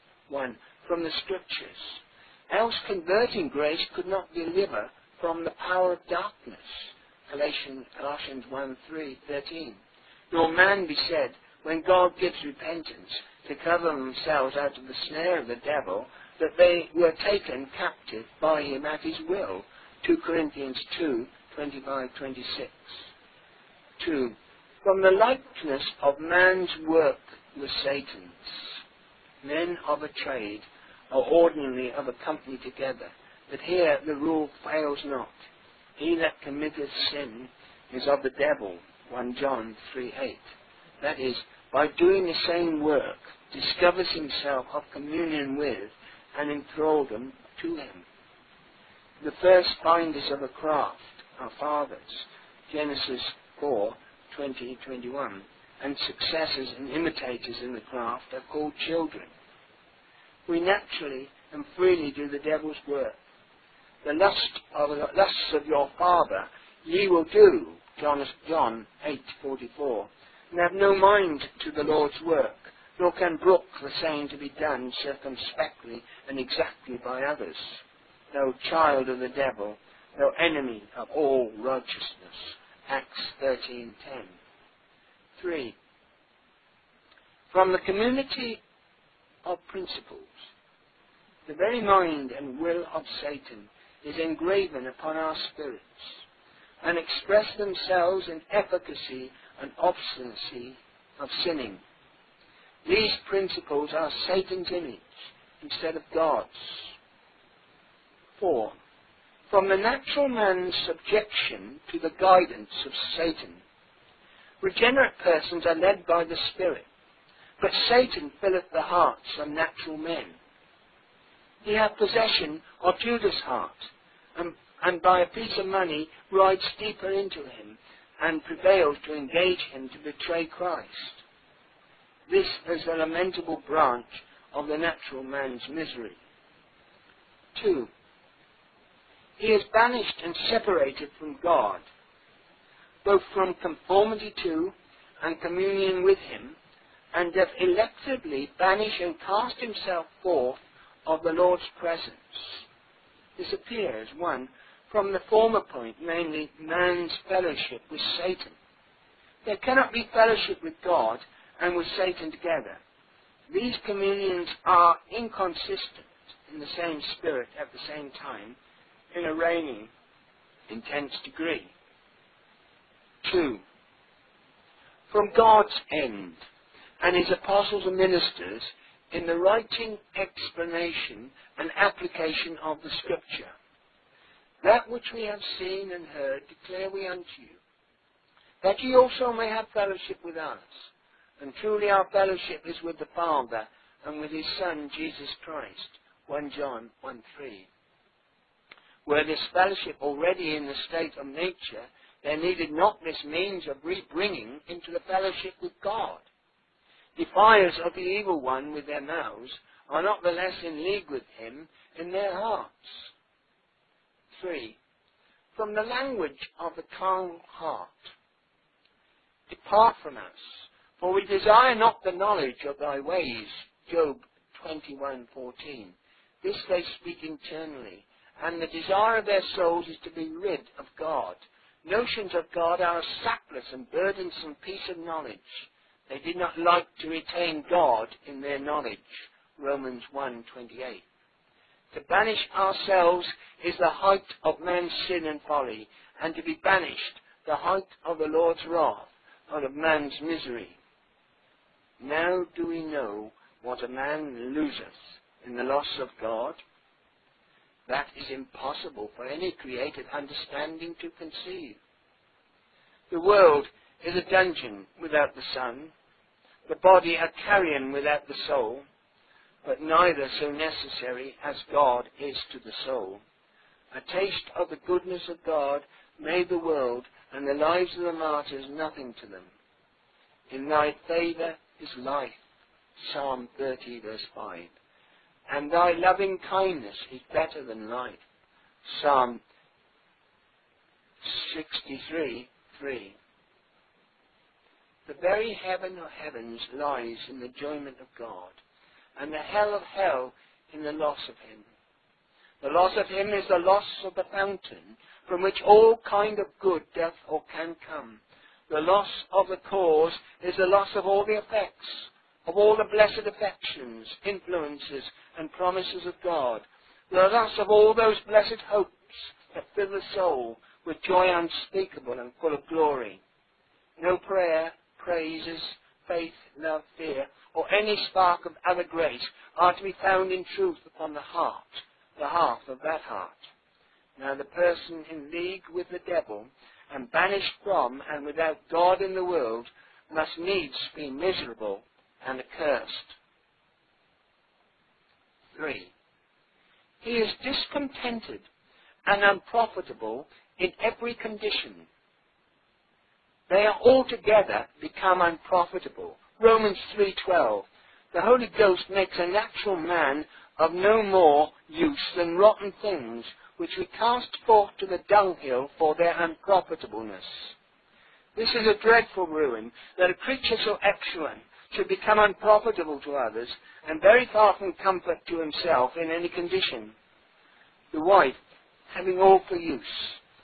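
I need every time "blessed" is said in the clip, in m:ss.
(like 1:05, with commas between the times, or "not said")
5:12, 5:18.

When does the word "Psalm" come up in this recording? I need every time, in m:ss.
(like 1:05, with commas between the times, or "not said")
4:43, 4:49.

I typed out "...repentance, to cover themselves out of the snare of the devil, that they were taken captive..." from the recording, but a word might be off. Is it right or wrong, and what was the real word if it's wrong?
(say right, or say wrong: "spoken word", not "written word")
right.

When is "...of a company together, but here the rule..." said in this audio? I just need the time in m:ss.
0:31.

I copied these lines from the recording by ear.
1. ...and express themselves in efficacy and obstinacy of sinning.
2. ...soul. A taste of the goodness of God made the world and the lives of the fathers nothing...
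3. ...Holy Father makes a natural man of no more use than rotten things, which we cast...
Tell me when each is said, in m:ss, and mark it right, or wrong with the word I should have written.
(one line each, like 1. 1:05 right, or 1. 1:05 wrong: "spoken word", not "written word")
1. 1:36 right
2. 4:32 wrong: "martyrs", not "fathers"
3. 5:58 wrong: "Ghost", not "Father".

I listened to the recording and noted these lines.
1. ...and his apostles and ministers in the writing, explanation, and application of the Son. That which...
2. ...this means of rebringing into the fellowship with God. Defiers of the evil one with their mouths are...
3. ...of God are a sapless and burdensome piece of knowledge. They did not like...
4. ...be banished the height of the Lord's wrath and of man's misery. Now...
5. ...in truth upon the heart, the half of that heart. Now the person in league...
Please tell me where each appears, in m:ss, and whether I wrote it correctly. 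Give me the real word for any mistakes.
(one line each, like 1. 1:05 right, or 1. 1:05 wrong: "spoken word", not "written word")
1. 2:57 wrong: "Scripture", not "Son"
2. 3:23 right
3. 3:52 right
4. 4:06 right
5. 5:30 right.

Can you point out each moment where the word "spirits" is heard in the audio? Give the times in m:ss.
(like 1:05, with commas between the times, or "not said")
1:35, 1:56, 2:47.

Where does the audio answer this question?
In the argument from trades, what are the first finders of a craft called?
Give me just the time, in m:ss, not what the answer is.
0:51.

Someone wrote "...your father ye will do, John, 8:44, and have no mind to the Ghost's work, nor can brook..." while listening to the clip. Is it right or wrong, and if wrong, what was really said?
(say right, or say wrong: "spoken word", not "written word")
wrong: "Lord", not "Ghost".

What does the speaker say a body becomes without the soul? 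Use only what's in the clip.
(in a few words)
A carrion.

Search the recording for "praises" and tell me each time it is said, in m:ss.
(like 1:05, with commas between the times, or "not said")
5:24.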